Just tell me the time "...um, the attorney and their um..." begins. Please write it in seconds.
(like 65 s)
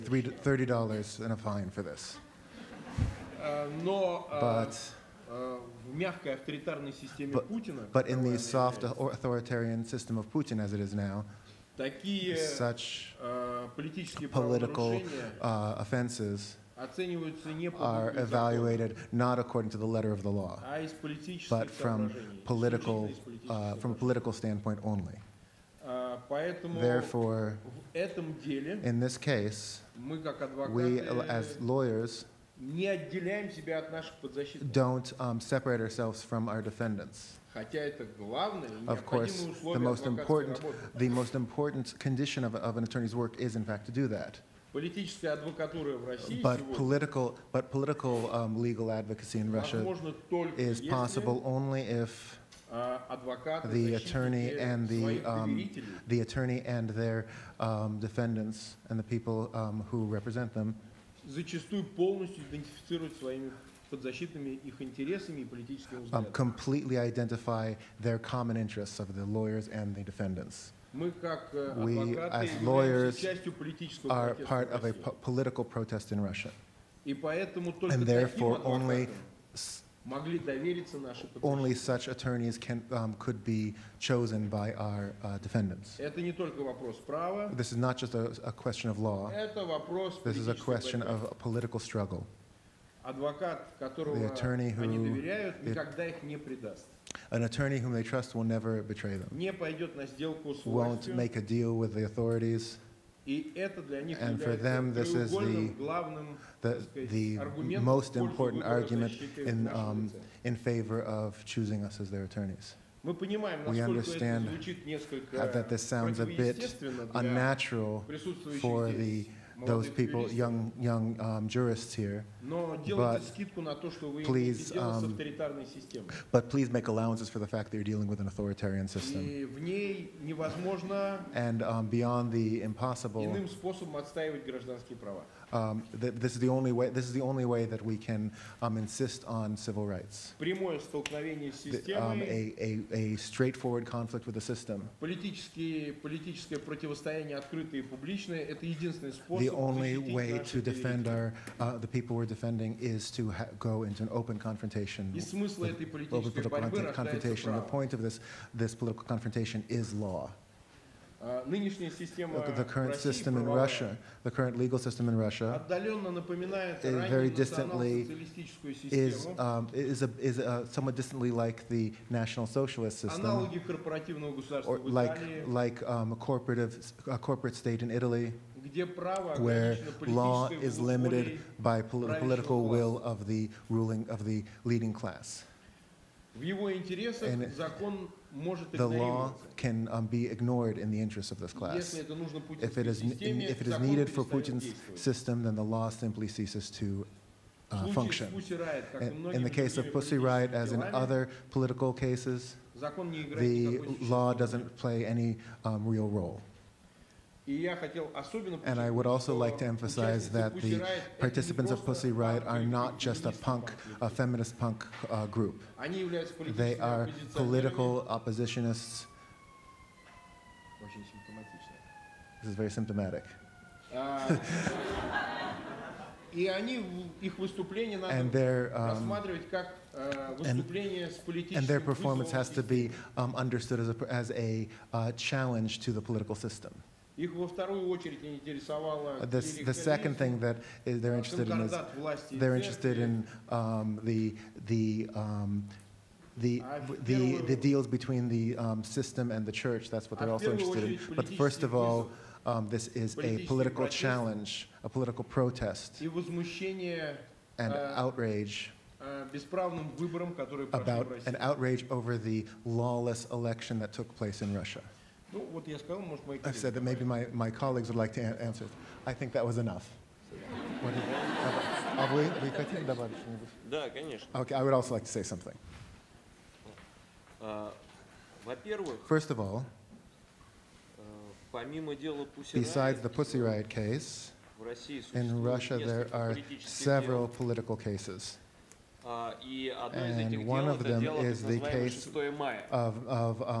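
55 s.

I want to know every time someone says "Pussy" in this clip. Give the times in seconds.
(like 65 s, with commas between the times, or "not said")
199 s, 211 s, 283 s.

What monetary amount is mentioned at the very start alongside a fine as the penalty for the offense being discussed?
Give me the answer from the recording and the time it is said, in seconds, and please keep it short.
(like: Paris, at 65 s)
$30, at 0 s.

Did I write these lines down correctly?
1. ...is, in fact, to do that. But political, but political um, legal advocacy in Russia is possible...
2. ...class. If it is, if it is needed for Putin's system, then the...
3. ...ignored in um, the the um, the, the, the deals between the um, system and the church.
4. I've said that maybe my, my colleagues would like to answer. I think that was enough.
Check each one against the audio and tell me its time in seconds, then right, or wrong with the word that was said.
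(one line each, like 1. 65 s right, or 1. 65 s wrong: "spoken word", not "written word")
1. 43 s right
2. 191 s right
3. 242 s wrong: "interested", not "ignored"
4. 266 s right.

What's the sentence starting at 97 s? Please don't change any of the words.
An attorney whom they trust will never betray them.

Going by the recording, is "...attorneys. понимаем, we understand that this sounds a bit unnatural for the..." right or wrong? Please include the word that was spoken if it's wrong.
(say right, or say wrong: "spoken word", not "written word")
right.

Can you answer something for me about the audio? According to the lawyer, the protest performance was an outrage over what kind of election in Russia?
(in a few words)
lawless election.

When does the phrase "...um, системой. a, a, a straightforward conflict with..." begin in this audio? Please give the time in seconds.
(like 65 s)
141 s.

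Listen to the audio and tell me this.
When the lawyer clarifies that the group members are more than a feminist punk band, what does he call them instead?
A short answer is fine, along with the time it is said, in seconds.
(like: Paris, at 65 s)
political oppositionists, at 217 s.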